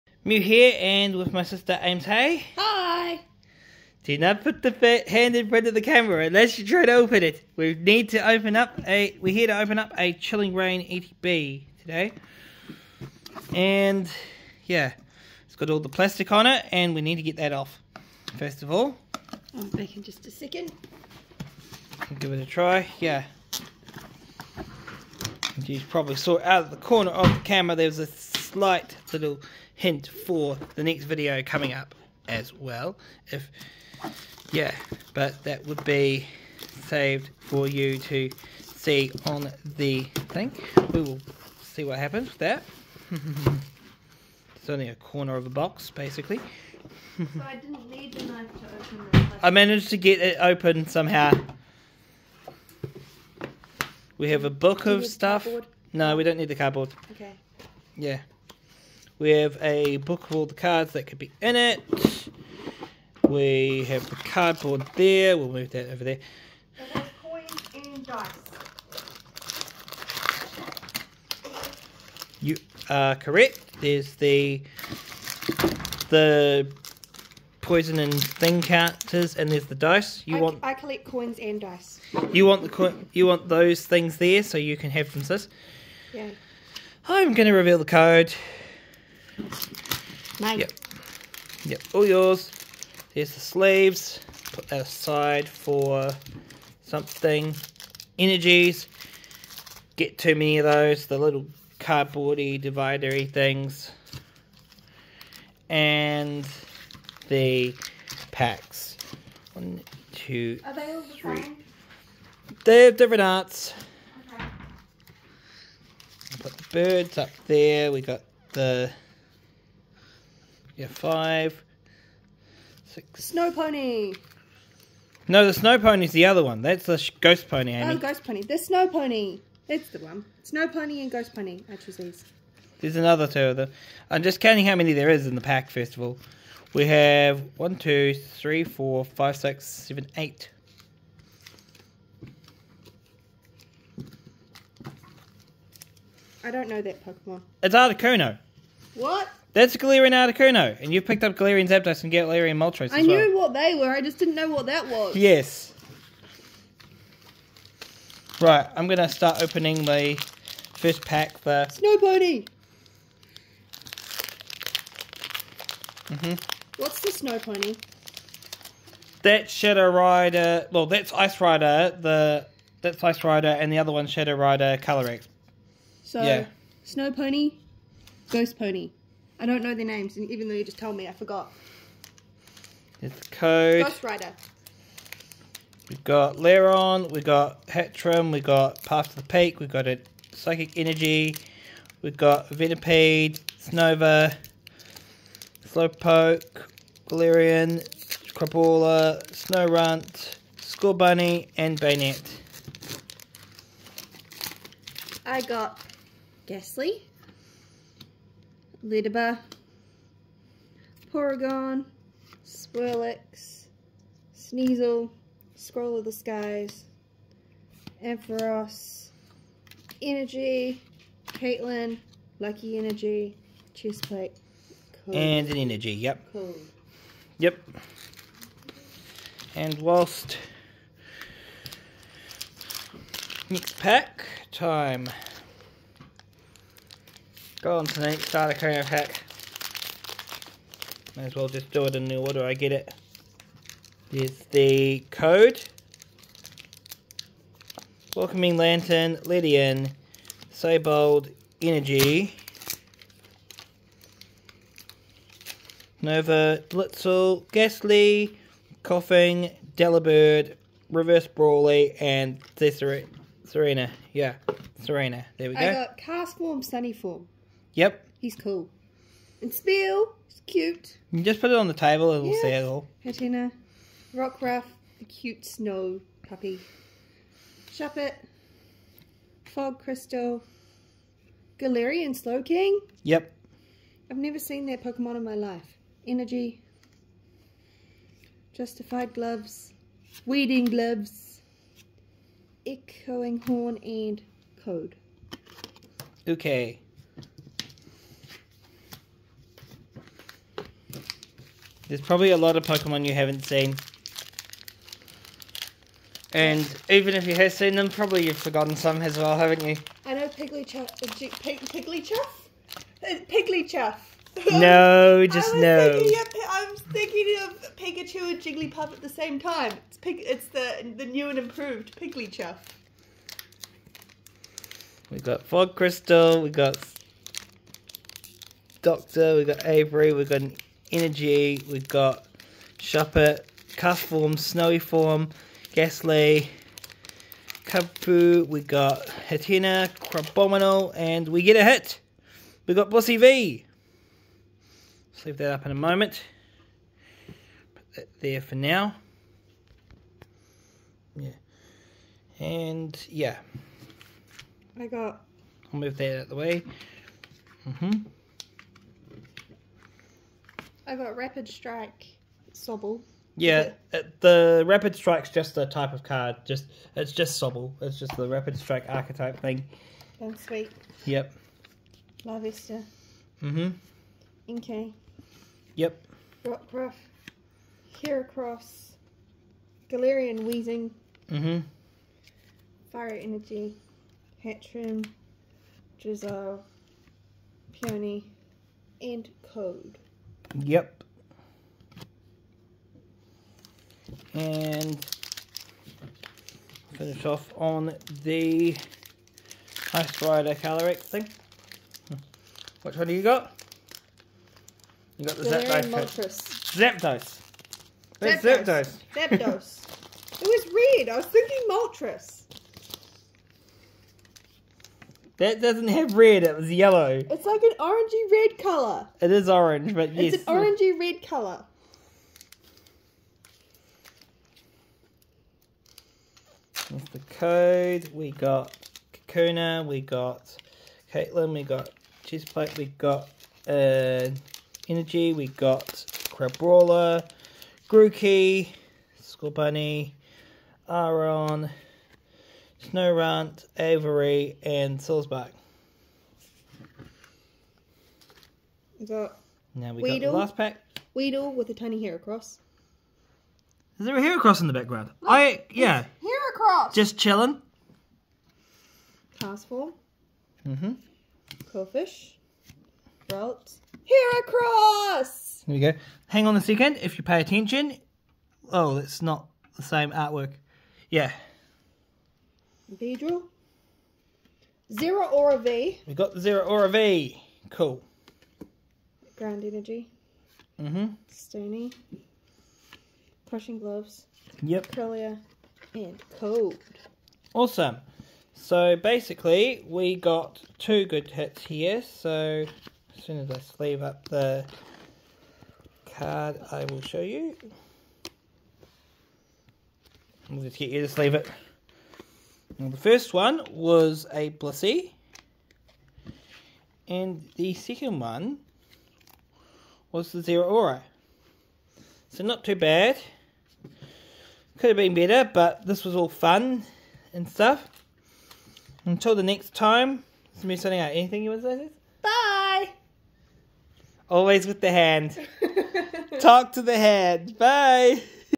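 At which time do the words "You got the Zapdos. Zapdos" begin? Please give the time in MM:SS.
06:45.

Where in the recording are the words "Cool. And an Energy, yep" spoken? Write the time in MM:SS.
03:45.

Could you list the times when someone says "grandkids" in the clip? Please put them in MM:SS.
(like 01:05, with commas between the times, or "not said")
not said.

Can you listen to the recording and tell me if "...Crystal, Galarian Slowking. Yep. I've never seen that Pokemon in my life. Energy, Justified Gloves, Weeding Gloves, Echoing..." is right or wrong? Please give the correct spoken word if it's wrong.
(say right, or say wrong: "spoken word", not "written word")
right.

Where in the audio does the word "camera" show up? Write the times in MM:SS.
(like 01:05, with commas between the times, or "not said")
00:05, 00:27.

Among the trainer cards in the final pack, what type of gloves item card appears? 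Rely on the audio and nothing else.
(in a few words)
Crushing Gloves.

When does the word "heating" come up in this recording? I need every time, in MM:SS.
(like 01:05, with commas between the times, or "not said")
not said.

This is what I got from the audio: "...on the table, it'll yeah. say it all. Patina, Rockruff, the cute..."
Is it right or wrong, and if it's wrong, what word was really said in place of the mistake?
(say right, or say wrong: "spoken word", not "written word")
right.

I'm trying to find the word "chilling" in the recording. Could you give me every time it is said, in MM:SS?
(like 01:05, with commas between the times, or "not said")
00:10, 07:37.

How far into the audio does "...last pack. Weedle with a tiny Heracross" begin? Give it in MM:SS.
07:30.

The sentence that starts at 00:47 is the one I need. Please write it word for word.
so I didn't need the knife to open this.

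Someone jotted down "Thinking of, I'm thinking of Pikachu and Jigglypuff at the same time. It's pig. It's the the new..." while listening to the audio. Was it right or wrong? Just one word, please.
right.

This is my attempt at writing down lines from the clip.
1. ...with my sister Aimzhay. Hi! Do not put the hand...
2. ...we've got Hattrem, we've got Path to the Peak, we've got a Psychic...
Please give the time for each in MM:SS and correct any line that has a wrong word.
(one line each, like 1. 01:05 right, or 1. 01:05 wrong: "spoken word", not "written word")
1. 00:01 right
2. 03:07 right.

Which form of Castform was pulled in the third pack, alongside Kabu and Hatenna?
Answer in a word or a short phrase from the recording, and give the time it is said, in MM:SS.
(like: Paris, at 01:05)
Snowy Form, at 05:34.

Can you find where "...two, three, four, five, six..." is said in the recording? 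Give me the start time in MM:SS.
02:17.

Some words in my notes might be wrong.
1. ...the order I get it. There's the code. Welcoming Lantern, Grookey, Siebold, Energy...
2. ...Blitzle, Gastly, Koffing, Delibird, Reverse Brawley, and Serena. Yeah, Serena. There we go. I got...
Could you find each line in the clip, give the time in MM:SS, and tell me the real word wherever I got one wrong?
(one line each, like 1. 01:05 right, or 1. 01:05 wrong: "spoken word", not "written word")
1. 04:02 wrong: "Lydian", not "Grookey"
2. 04:16 right.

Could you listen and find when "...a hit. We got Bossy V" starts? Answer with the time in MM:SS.
05:41.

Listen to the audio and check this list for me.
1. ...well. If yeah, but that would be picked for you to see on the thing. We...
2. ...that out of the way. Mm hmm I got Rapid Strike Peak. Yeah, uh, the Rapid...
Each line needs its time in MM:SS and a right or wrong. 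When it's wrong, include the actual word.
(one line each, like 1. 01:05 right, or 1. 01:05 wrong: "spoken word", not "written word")
1. 00:32 wrong: "saved", not "picked"
2. 05:55 wrong: "Sobble", not "Peak".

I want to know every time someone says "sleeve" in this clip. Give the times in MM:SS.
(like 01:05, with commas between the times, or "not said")
01:33, 08:13, 08:21.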